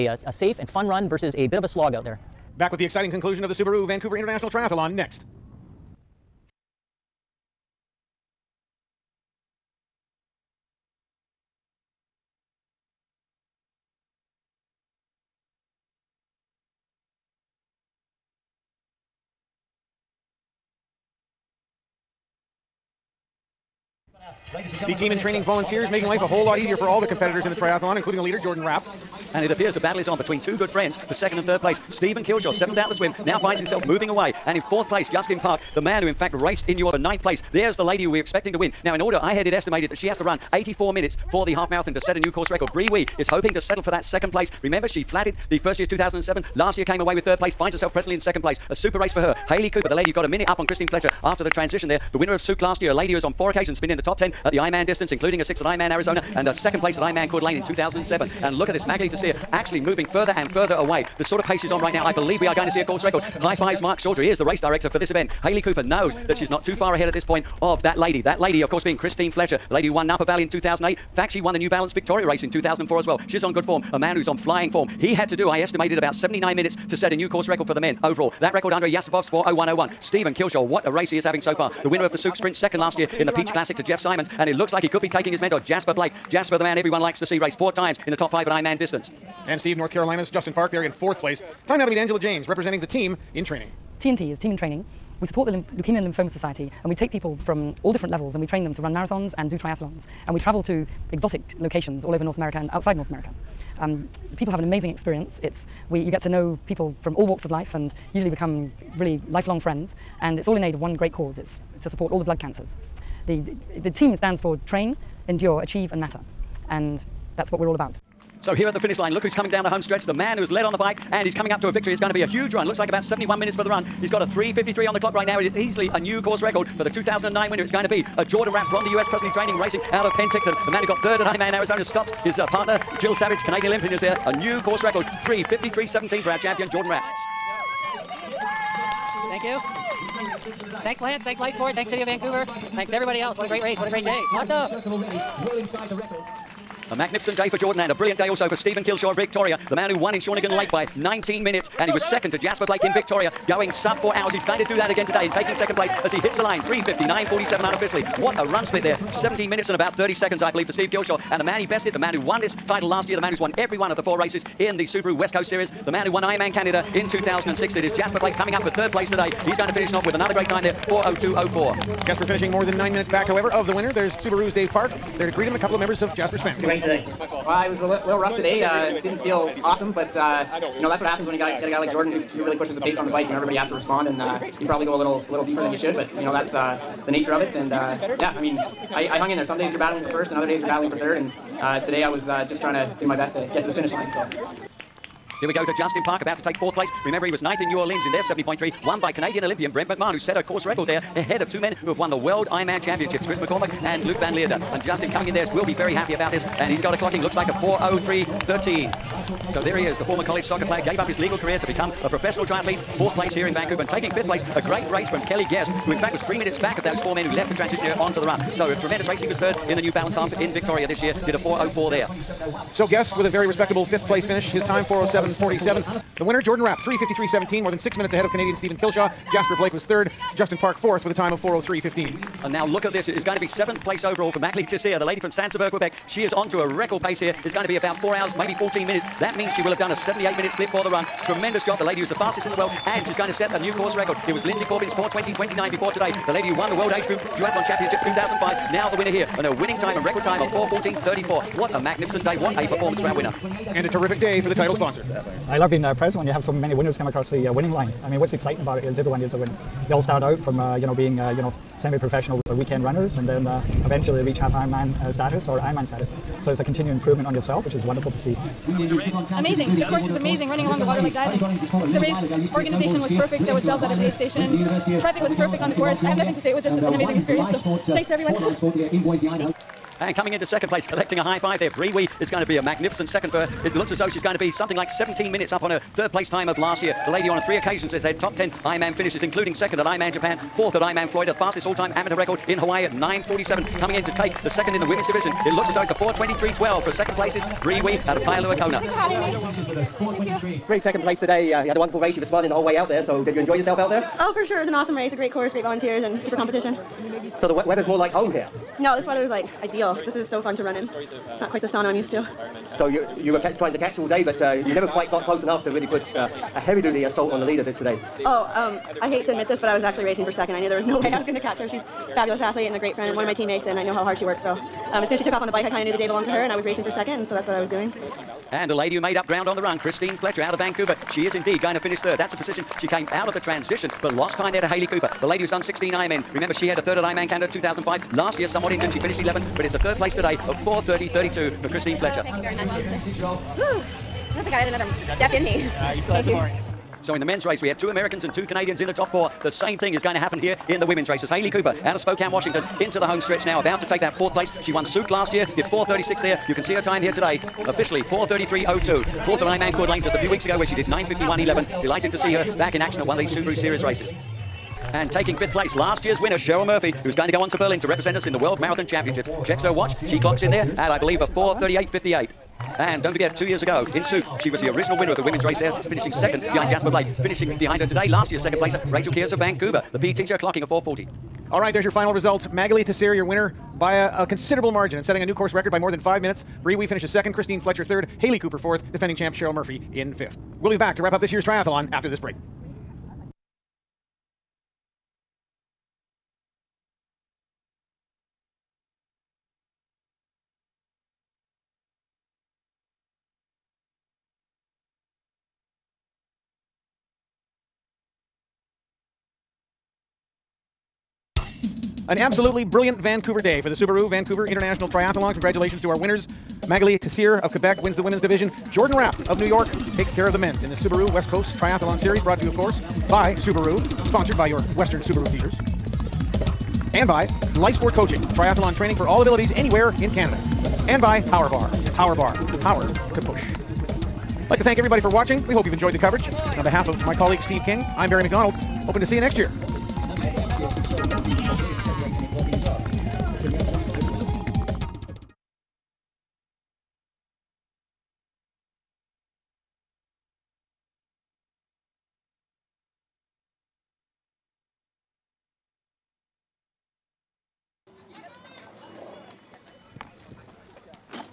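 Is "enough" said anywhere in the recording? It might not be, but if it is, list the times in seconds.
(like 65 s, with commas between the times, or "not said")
315 s.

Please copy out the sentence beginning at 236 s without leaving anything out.
She is on to a record pace here.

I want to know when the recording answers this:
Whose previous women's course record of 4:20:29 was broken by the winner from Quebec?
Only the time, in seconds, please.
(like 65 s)
244 s.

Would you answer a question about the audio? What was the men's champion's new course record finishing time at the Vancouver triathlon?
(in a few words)
3:53:17.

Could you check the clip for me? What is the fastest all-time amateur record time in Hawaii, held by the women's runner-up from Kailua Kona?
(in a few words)
9:47.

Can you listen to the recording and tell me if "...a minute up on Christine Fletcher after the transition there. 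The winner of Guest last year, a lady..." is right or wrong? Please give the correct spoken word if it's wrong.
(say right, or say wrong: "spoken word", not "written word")
wrong: "Sooke", not "Guest".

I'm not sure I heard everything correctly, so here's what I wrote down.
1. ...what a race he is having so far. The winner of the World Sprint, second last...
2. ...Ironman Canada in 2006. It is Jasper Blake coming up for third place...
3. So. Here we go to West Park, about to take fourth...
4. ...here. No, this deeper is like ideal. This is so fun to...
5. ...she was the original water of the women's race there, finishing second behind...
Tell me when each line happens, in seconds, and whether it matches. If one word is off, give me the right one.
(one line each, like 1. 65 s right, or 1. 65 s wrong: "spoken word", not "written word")
1. 80 s wrong: "Sooke", not "World"
2. 166 s right
3. 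194 s wrong: "Justin", not "West"
4. 308 s wrong: "weather", not "deeper"
5. 374 s wrong: "winner", not "water".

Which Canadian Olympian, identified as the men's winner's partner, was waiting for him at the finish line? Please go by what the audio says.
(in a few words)
Jill Savege.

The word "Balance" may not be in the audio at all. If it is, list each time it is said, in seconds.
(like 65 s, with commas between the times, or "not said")
71 s, 219 s.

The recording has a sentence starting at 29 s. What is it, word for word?
And it appears the battle is on between two good friends for second and third place.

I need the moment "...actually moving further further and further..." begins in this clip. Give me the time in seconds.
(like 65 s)
59 s.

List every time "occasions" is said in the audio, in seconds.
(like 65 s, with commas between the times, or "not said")
53 s, 287 s.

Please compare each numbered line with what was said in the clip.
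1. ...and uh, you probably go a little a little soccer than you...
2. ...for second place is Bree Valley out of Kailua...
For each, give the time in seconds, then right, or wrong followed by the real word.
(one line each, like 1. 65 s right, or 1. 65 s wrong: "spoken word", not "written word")
1. 184 s wrong: "deeper", not "soccer"
2. 296 s wrong: "Wee", not "Valley".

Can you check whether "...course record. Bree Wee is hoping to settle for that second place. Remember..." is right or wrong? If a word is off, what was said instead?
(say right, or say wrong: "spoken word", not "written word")
right.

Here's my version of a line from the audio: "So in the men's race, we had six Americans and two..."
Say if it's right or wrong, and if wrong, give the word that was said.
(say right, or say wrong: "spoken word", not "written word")
wrong: "two", not "six".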